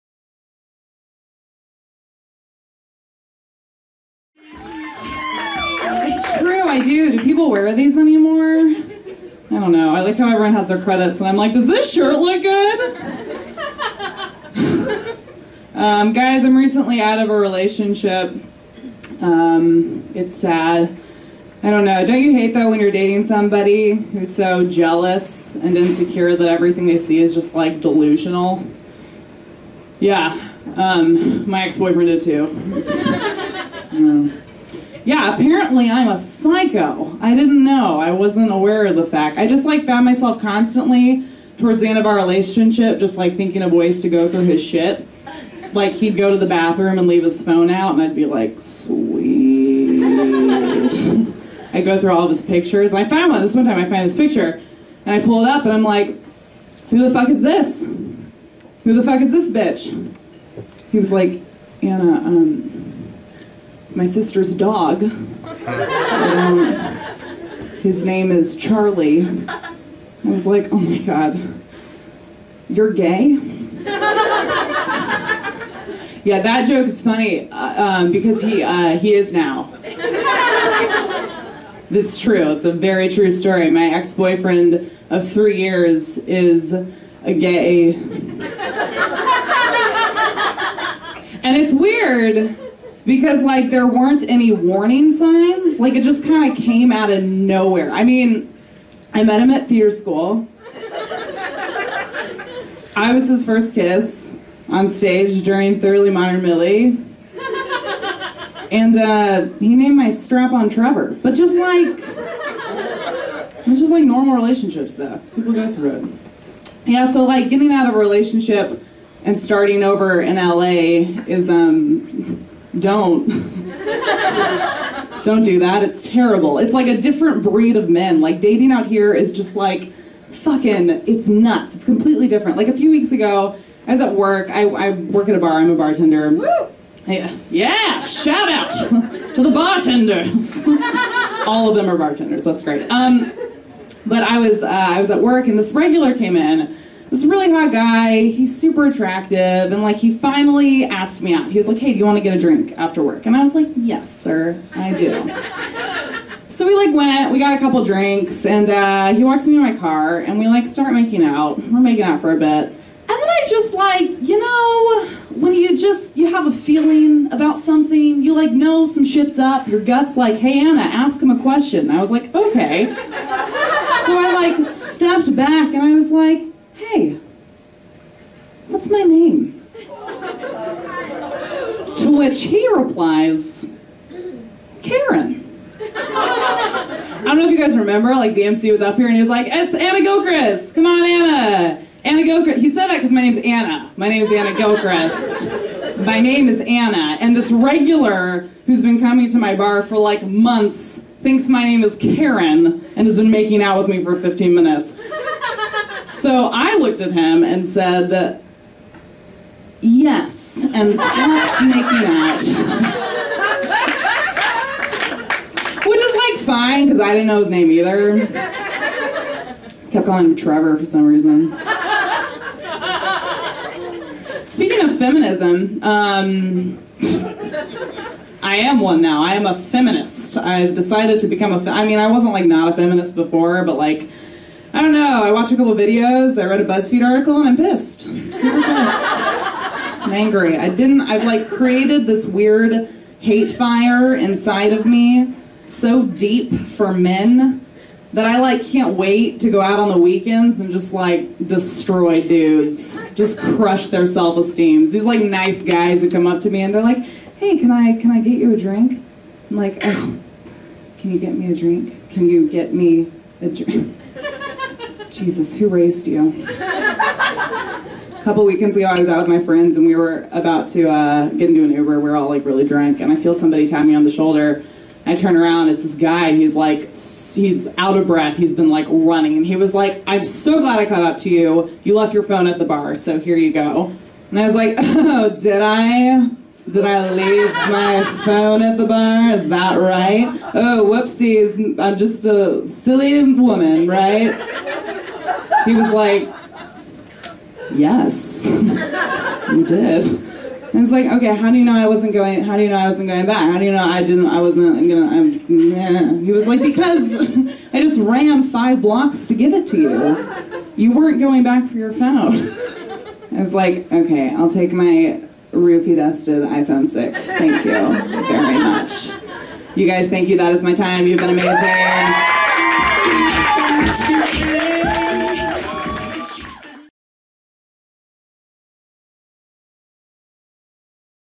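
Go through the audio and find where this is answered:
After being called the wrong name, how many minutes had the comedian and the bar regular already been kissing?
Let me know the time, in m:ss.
3:24.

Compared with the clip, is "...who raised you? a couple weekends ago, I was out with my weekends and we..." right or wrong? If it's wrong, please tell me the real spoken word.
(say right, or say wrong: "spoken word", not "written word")
wrong: "friends", not "weekends".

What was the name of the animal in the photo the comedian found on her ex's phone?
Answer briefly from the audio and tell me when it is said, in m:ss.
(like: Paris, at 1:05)
Charlie, at 1:08.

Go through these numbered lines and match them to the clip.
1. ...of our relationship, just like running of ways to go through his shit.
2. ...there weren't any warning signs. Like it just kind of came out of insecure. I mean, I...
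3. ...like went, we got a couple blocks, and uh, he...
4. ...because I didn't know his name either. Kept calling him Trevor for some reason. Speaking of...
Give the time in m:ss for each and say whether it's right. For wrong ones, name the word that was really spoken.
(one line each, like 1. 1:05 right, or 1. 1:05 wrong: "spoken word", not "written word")
1. 0:41 wrong: "thinking", not "running"
2. 1:33 wrong: "nowhere", not "insecure"
3. 2:36 wrong: "drinks", not "blocks"
4. 3:36 right.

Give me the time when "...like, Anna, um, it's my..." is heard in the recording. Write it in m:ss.
1:01.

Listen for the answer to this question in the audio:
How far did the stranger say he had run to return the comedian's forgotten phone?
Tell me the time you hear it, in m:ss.
5:08.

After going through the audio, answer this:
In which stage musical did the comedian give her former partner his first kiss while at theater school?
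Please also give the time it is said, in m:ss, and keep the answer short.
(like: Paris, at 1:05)
Thoroughly Modern Millie, at 1:45.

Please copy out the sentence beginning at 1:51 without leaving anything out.
But just like, it's just like normal relationship stuff.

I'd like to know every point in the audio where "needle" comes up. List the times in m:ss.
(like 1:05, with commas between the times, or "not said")
not said.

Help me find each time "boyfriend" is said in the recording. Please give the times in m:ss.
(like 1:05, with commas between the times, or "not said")
0:31, 1:23.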